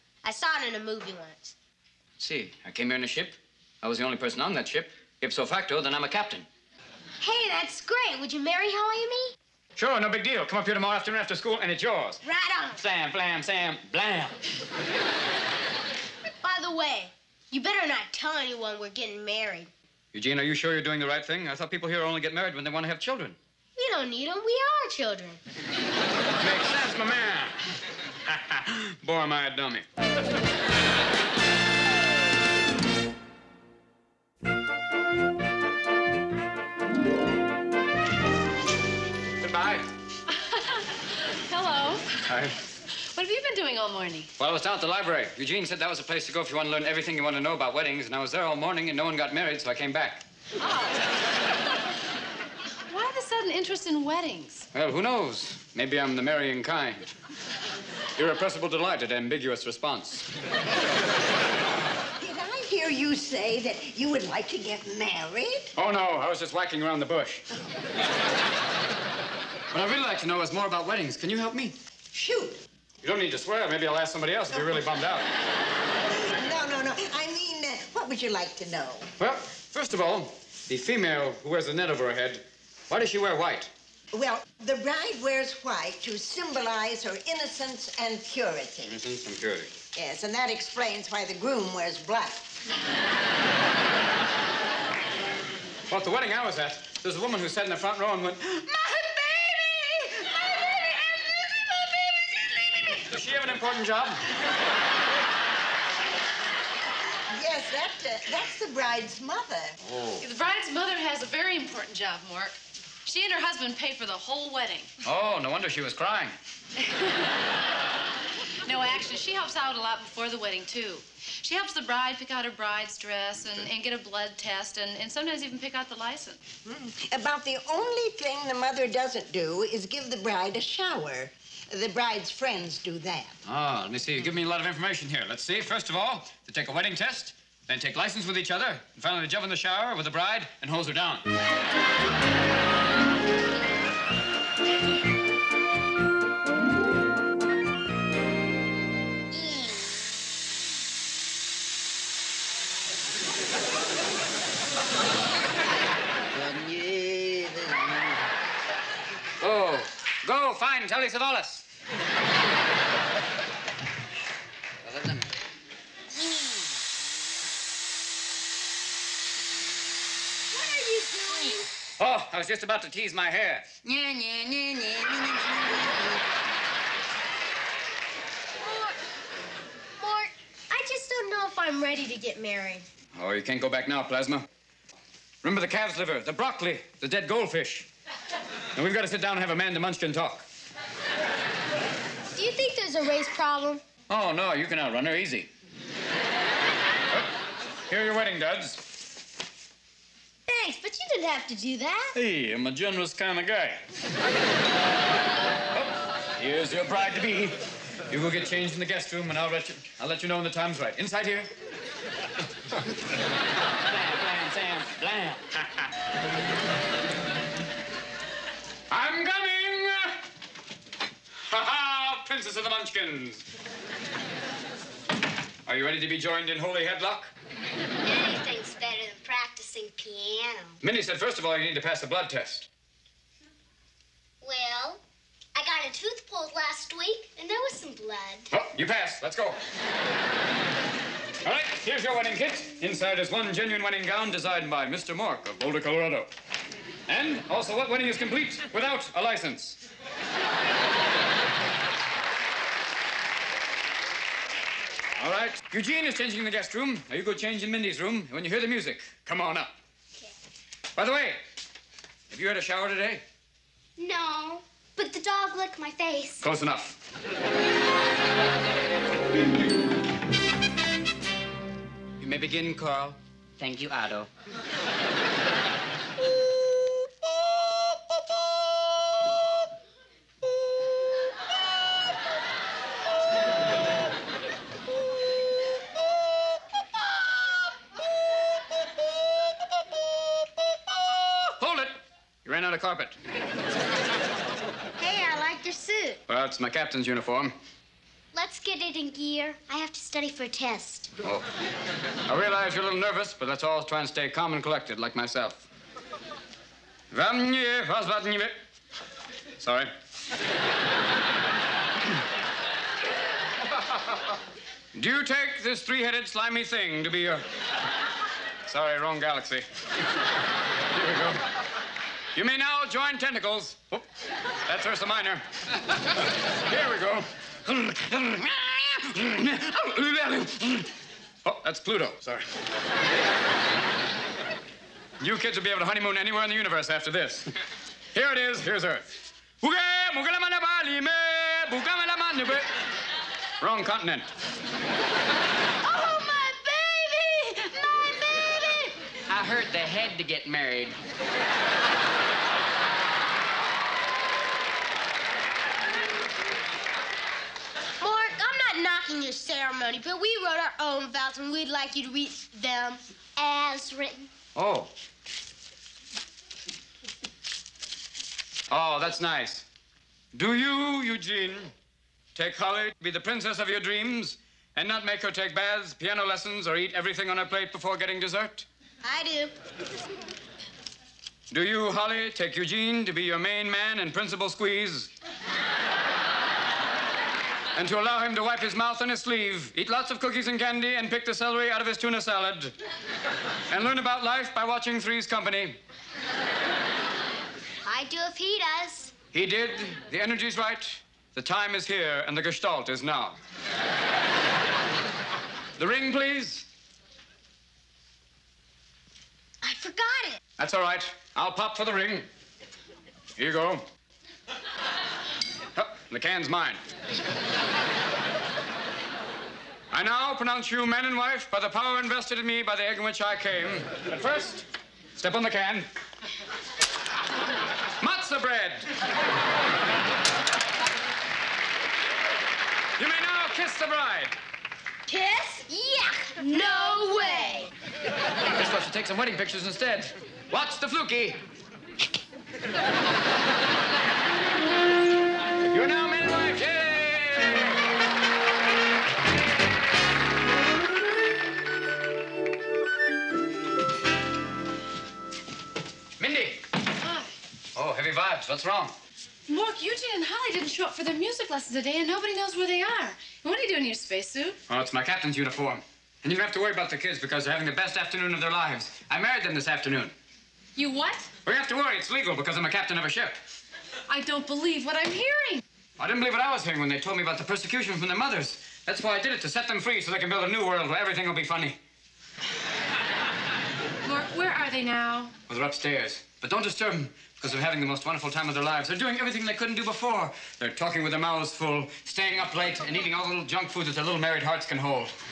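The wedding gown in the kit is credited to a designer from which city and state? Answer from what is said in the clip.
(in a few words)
Boulder, Colorado.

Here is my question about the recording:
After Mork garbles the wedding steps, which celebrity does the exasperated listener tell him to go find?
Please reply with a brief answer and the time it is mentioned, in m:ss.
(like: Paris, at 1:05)
Telly Savalas, at 2:40.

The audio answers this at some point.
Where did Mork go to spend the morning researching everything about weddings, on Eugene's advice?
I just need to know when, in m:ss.
0:44.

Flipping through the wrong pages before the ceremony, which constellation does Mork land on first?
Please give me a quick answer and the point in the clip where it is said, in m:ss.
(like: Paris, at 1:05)
Ursa Minor, at 5:24.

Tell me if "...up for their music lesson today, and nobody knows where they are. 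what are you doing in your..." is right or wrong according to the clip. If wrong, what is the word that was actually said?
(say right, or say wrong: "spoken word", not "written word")
right.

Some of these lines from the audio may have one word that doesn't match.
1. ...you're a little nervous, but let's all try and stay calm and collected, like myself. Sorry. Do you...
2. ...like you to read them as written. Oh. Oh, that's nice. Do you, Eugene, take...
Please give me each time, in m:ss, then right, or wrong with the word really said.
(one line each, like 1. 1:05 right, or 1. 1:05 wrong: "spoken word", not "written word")
1. 5:02 right
2. 6:01 right.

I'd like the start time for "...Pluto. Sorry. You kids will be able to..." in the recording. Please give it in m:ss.
5:31.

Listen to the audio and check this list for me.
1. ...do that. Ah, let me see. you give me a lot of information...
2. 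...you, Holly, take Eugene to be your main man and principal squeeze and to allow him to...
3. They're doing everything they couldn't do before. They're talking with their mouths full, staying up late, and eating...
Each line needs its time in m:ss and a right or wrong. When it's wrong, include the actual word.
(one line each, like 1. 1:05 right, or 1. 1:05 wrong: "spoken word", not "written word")
1. 2:12 right
2. 6:21 right
3. 8:08 right.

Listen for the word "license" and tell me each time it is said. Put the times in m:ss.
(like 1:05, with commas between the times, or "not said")
2:05, 2:17, 4:09.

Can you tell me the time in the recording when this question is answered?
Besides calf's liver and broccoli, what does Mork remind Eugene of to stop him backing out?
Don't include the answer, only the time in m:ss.
3:07.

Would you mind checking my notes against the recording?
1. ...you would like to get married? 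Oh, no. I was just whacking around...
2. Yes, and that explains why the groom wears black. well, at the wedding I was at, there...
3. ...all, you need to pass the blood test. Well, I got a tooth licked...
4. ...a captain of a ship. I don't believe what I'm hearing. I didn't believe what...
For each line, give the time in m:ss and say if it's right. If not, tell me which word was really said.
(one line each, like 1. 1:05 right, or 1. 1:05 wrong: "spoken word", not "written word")
1. 1:03 right
2. 1:29 right
3. 3:51 wrong: "pulled", not "licked"
4. 7:52 right.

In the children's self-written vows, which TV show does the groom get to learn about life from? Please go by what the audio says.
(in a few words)
Three's Company.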